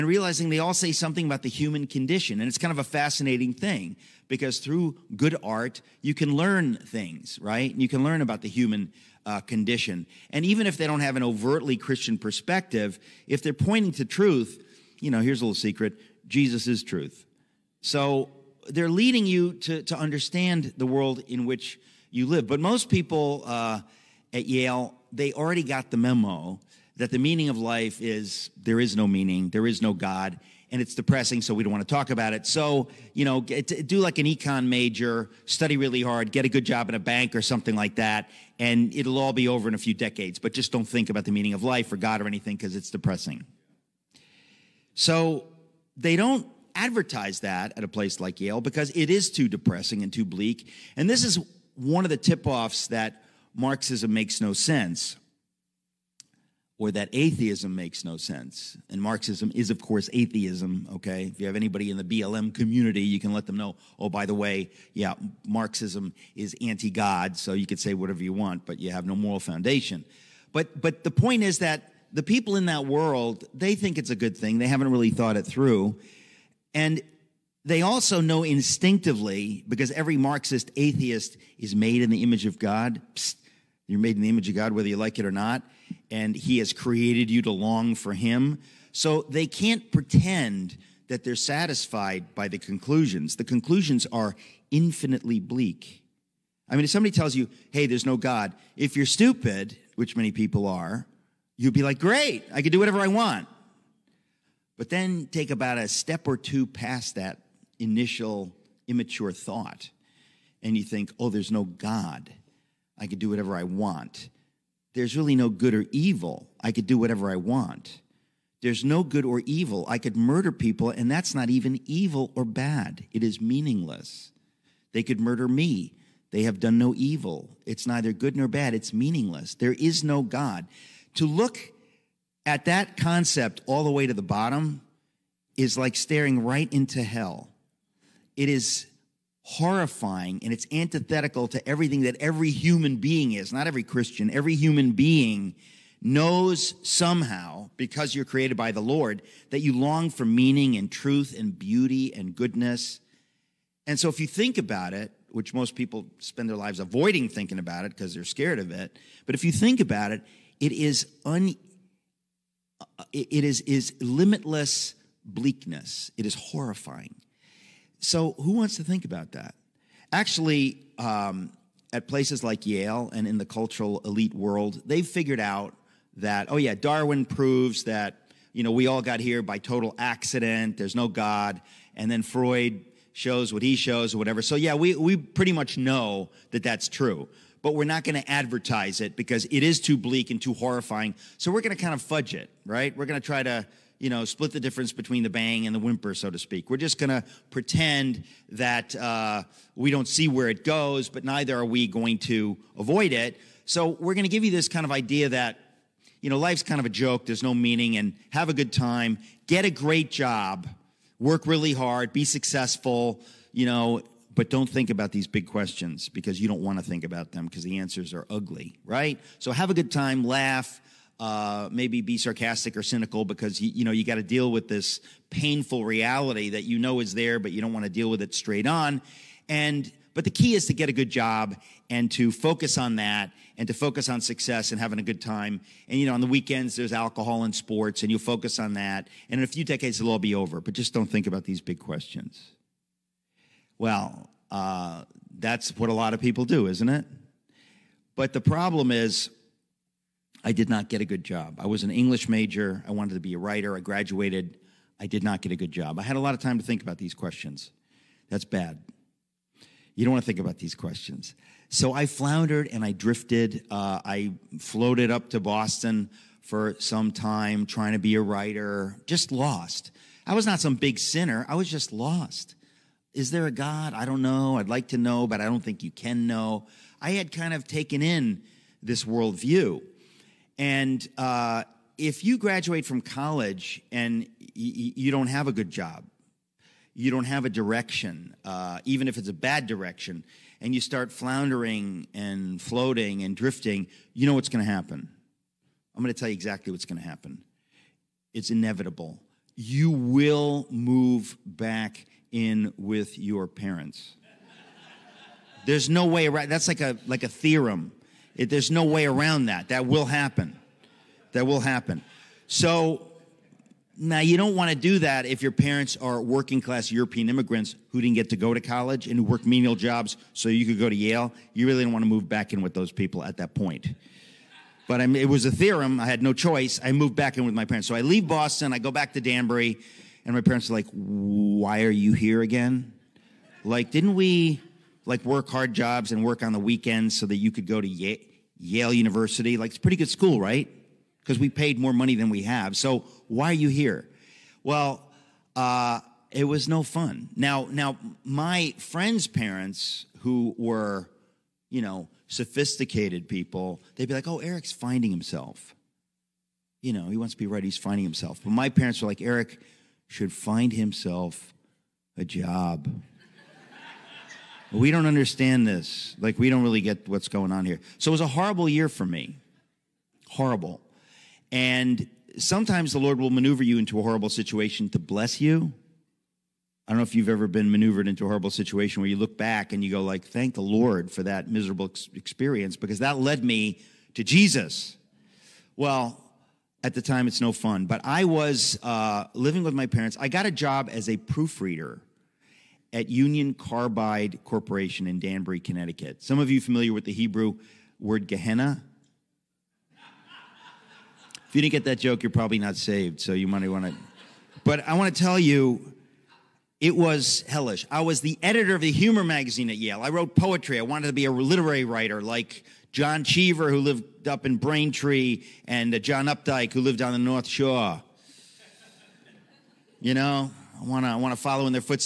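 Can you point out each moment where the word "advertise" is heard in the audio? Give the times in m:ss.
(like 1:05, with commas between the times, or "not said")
0:46, 3:08.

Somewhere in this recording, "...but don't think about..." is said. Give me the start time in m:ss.
3:34.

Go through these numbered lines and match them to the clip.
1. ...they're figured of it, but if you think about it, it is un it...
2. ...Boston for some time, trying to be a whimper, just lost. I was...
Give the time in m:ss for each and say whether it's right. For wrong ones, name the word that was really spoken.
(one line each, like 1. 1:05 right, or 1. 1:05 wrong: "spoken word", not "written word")
1. 2:38 wrong: "scared", not "figured"
2. 4:25 wrong: "writer", not "whimper".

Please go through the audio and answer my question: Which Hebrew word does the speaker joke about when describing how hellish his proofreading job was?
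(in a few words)
Gehenna.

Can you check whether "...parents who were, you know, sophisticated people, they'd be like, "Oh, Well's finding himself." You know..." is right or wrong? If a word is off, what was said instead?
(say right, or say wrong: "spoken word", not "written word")
wrong: "Eric", not "Well".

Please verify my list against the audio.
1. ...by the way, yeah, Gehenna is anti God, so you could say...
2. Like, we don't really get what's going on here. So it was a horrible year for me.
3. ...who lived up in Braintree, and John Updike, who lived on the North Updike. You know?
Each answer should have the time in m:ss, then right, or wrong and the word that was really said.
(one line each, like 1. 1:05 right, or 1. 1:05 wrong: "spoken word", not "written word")
1. 1:04 wrong: "Marxism", not "Gehenna"
2. 6:06 right
3. 6:53 wrong: "Shore", not "Updike".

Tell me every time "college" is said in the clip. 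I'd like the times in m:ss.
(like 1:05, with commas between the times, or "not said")
4:43, 5:18.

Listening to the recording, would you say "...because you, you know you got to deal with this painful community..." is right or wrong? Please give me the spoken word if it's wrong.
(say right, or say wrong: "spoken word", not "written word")
wrong: "reality", not "community".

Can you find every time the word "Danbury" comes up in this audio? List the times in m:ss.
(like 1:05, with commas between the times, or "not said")
5:29, 6:35.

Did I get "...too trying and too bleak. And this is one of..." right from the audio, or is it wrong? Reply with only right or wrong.
wrong.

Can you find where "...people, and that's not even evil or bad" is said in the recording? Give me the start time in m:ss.
2:00.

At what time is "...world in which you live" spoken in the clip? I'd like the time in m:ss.
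0:20.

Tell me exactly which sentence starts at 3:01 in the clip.
And then Freud shows what he shows or whatever.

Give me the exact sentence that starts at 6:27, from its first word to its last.
But I was uh, living with my parents.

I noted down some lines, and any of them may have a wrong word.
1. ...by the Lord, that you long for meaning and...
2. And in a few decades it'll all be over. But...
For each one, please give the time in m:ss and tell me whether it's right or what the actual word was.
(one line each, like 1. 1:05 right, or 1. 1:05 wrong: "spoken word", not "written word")
1. 2:28 right
2. 3:59 right.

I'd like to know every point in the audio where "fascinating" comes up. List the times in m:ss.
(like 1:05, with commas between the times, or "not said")
0:02.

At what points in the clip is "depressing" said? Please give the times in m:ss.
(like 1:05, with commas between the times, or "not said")
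0:30, 0:42, 0:49.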